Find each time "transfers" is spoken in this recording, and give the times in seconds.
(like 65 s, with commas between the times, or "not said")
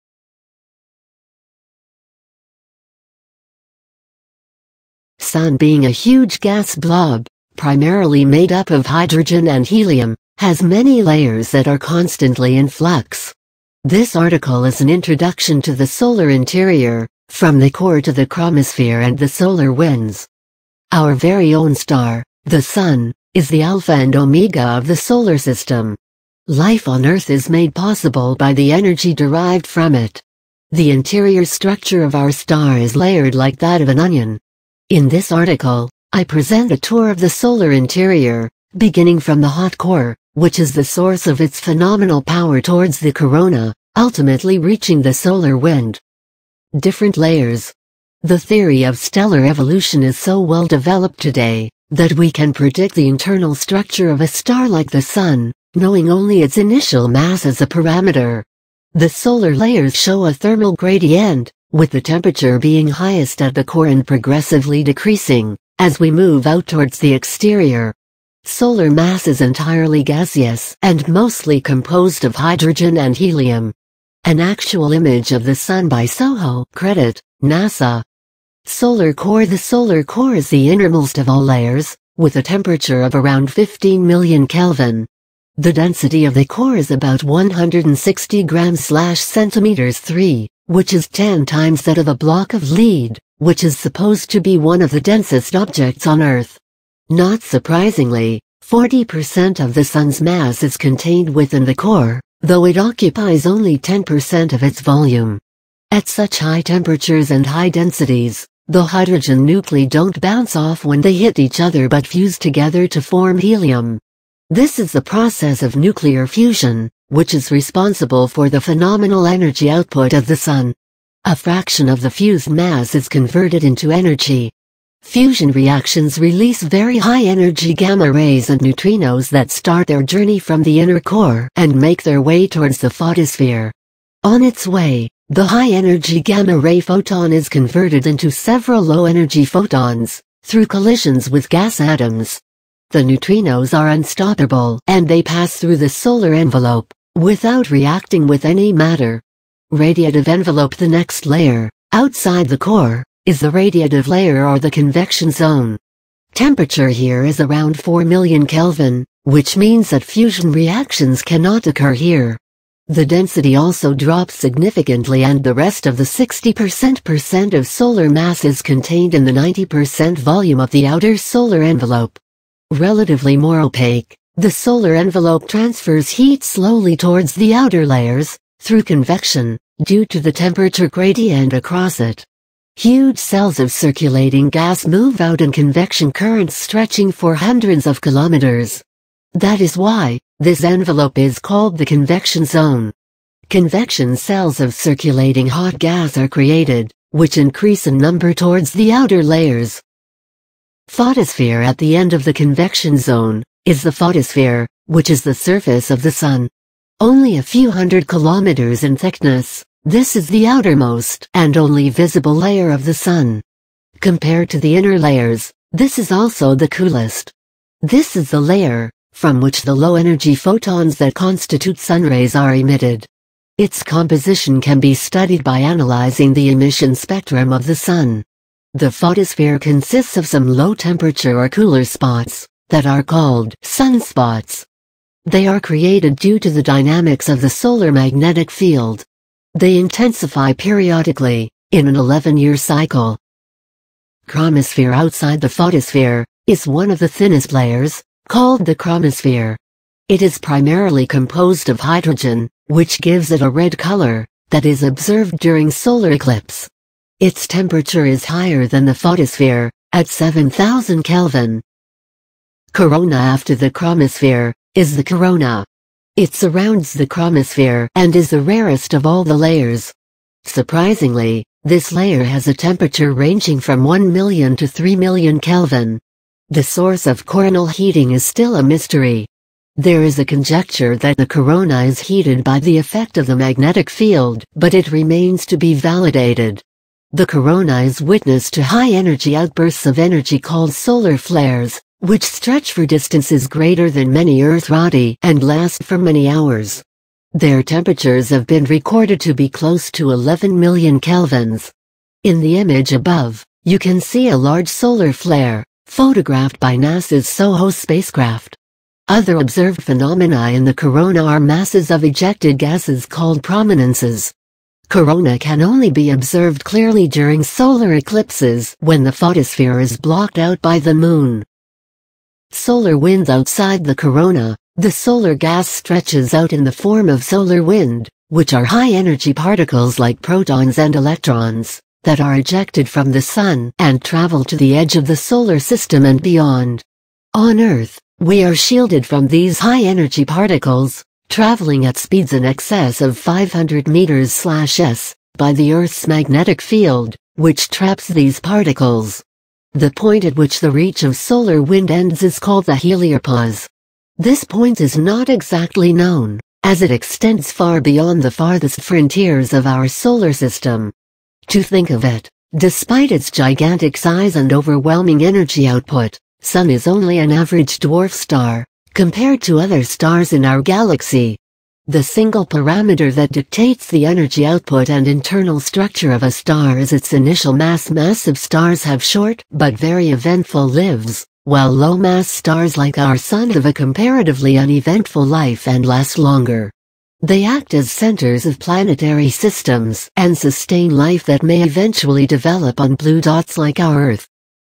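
175 s.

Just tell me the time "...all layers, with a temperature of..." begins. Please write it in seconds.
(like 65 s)
81 s.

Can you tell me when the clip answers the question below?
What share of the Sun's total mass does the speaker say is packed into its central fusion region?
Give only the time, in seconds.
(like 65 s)
98 s.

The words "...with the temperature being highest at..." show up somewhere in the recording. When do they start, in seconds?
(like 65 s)
61 s.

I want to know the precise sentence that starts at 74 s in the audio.
An actual image of the Sun by SOHO, credit, NASA.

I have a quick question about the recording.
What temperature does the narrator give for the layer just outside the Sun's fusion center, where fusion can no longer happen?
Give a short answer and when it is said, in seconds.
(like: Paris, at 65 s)
4 million Kelvin, at 157 s.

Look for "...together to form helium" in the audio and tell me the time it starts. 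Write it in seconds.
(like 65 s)
112 s.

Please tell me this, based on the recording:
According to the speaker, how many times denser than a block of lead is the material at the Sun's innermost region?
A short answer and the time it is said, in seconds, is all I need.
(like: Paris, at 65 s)
10 times, at 91 s.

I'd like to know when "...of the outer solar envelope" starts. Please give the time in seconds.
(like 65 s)
170 s.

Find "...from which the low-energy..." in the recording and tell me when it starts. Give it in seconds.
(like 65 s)
219 s.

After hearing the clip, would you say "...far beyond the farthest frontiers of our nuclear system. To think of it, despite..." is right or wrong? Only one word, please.
wrong.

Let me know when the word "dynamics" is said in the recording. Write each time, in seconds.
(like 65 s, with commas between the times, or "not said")
236 s.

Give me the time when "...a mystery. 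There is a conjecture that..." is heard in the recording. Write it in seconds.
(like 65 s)
278 s.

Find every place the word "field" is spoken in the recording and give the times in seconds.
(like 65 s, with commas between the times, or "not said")
238 s, 283 s, 346 s.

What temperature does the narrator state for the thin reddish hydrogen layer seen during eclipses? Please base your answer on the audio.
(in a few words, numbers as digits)
7000 Kelvin.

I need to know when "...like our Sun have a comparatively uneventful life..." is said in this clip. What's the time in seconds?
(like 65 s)
382 s.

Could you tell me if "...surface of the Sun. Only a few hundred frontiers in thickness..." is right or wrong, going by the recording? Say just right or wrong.
wrong.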